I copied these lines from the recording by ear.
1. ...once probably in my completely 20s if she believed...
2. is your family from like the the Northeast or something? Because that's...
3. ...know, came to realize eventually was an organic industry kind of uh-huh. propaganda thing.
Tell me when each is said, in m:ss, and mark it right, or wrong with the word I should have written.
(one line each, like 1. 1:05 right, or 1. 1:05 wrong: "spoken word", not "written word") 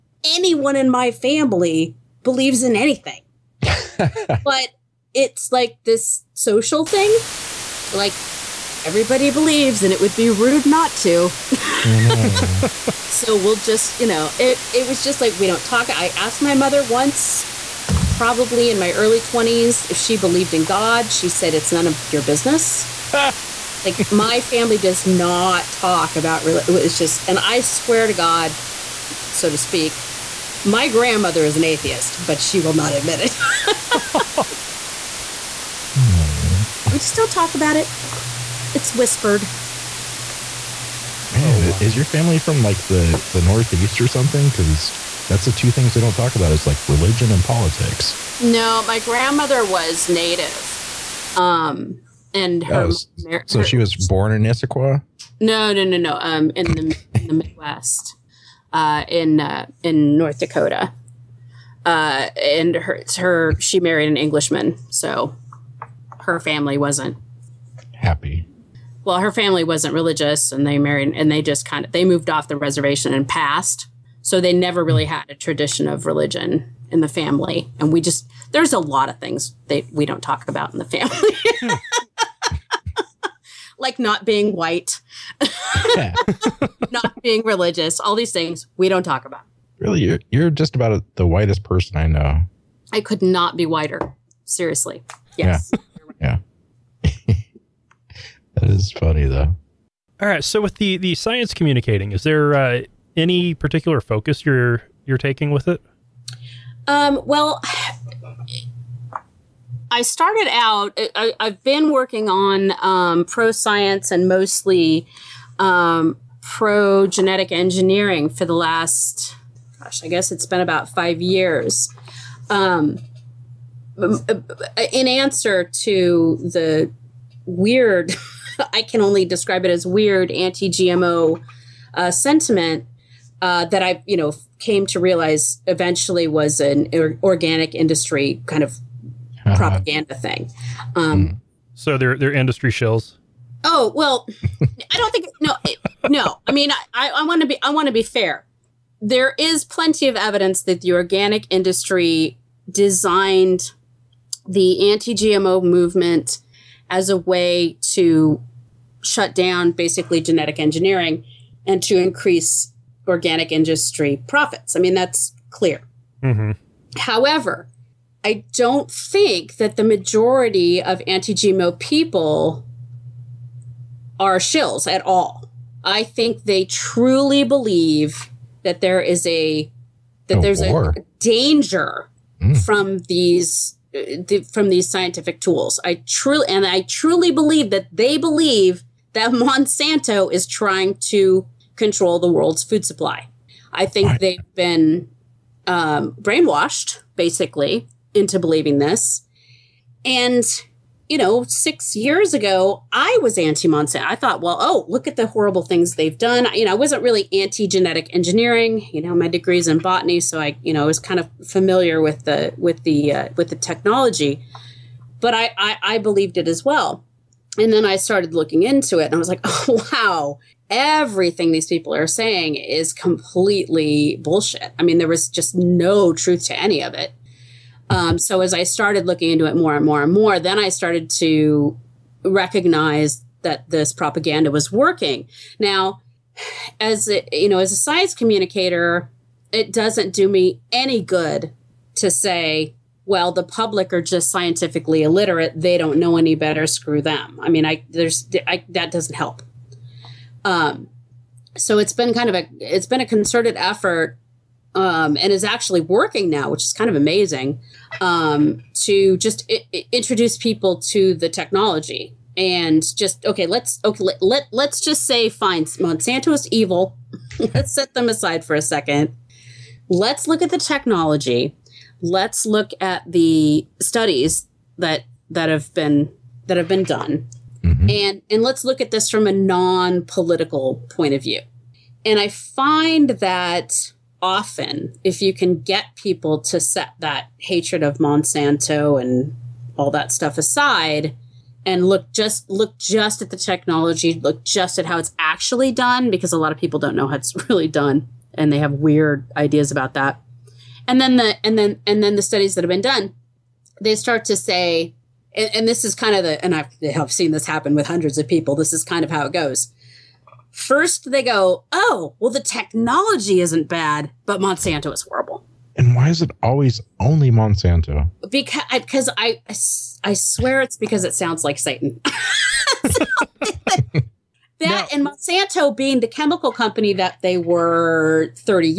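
1. 0:16 wrong: "early", not "completely"
2. 0:41 right
3. 2:14 right.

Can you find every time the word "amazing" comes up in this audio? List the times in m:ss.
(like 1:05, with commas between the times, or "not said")
4:16.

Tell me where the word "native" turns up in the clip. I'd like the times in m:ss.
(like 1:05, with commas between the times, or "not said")
0:50.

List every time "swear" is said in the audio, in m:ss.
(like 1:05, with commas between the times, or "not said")
0:27, 5:20.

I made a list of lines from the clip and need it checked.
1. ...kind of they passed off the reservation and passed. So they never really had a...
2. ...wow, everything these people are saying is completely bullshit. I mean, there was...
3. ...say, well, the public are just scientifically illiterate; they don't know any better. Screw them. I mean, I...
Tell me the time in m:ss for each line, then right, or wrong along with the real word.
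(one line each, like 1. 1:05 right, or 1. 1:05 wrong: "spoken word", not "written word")
1. 1:11 wrong: "moved", not "passed"
2. 3:39 right
3. 4:02 right.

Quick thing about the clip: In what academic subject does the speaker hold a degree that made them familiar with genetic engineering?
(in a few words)
Botany.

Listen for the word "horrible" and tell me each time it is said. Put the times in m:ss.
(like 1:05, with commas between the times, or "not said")
3:25, 5:15.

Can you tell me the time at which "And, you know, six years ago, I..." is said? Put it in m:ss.
3:20.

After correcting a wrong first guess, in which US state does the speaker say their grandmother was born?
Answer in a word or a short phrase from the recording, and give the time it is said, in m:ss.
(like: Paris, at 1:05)
North Dakota, at 1:00.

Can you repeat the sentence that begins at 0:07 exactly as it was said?
Like everybody believes and it would be rude not to.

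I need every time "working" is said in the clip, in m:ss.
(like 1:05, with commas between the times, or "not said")
1:51, 3:54, 4:15.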